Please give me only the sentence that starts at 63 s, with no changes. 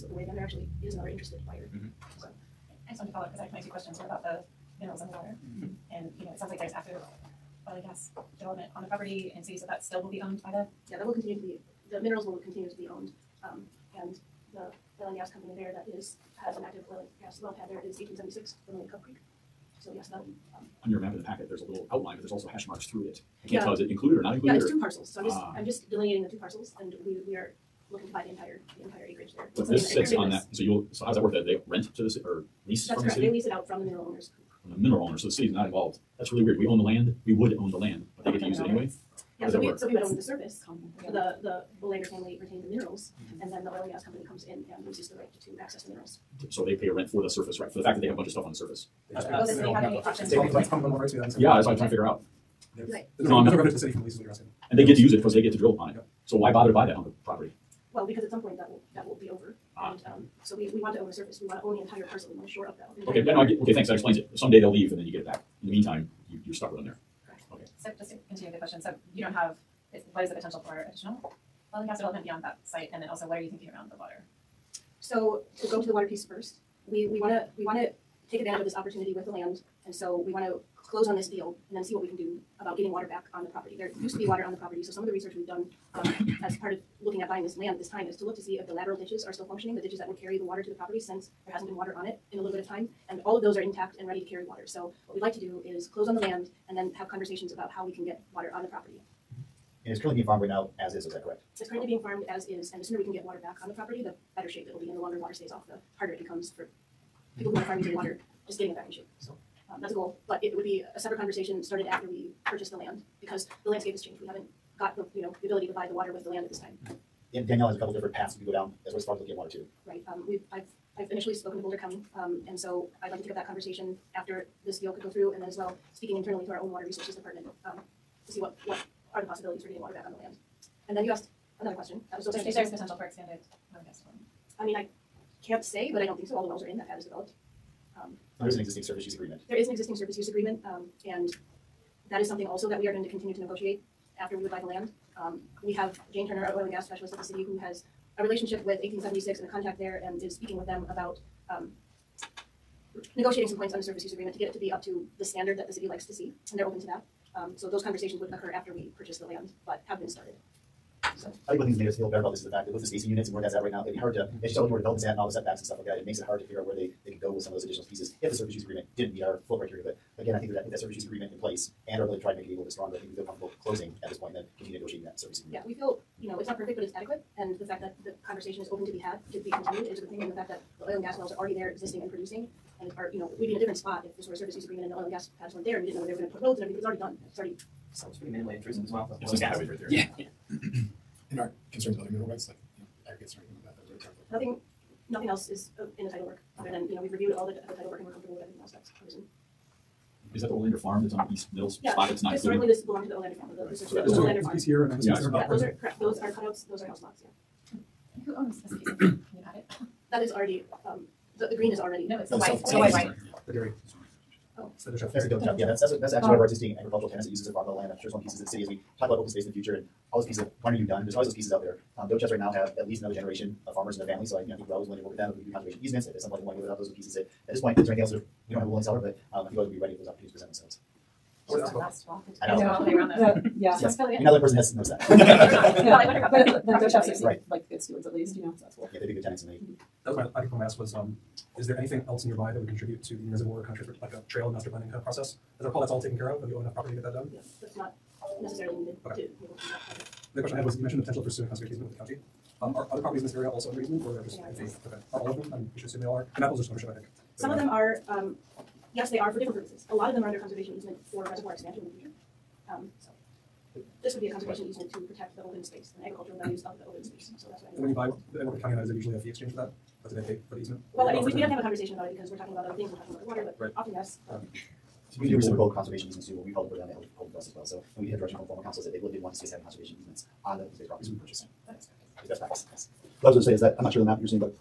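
Okay, yeah, no, I get, okay, thanks, that explains it someday they'll leave and then you get it back.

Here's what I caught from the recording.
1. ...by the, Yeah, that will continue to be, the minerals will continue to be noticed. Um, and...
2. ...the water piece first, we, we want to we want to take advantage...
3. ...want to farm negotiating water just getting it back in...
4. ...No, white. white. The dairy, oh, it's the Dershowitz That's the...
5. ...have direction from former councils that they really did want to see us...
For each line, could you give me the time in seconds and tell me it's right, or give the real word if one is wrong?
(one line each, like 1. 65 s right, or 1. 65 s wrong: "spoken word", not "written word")
1. 10 s wrong: "owned", not "noticed"
2. 75 s right
3. 107 s wrong: "using", not "negotiating"
4. 212 s right
5. 278 s right.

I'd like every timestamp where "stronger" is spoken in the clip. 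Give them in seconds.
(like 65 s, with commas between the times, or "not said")
172 s.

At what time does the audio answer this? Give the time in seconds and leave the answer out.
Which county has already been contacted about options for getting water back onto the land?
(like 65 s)
121 s.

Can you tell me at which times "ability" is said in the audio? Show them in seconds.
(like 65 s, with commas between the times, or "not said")
115 s, 172 s.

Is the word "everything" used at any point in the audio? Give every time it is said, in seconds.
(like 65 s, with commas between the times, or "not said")
186 s, 198 s.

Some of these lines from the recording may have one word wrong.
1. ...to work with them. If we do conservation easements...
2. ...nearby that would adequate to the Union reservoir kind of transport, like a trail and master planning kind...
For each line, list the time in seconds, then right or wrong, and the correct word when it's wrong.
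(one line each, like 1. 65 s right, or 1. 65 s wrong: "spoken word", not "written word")
1. 224 s right
2. 242 s wrong: "contribute", not "adequate".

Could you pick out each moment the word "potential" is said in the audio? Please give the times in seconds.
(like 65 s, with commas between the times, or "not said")
70 s, 132 s, 251 s.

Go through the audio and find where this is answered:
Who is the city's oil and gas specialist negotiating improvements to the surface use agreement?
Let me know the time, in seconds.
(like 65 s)
146 s.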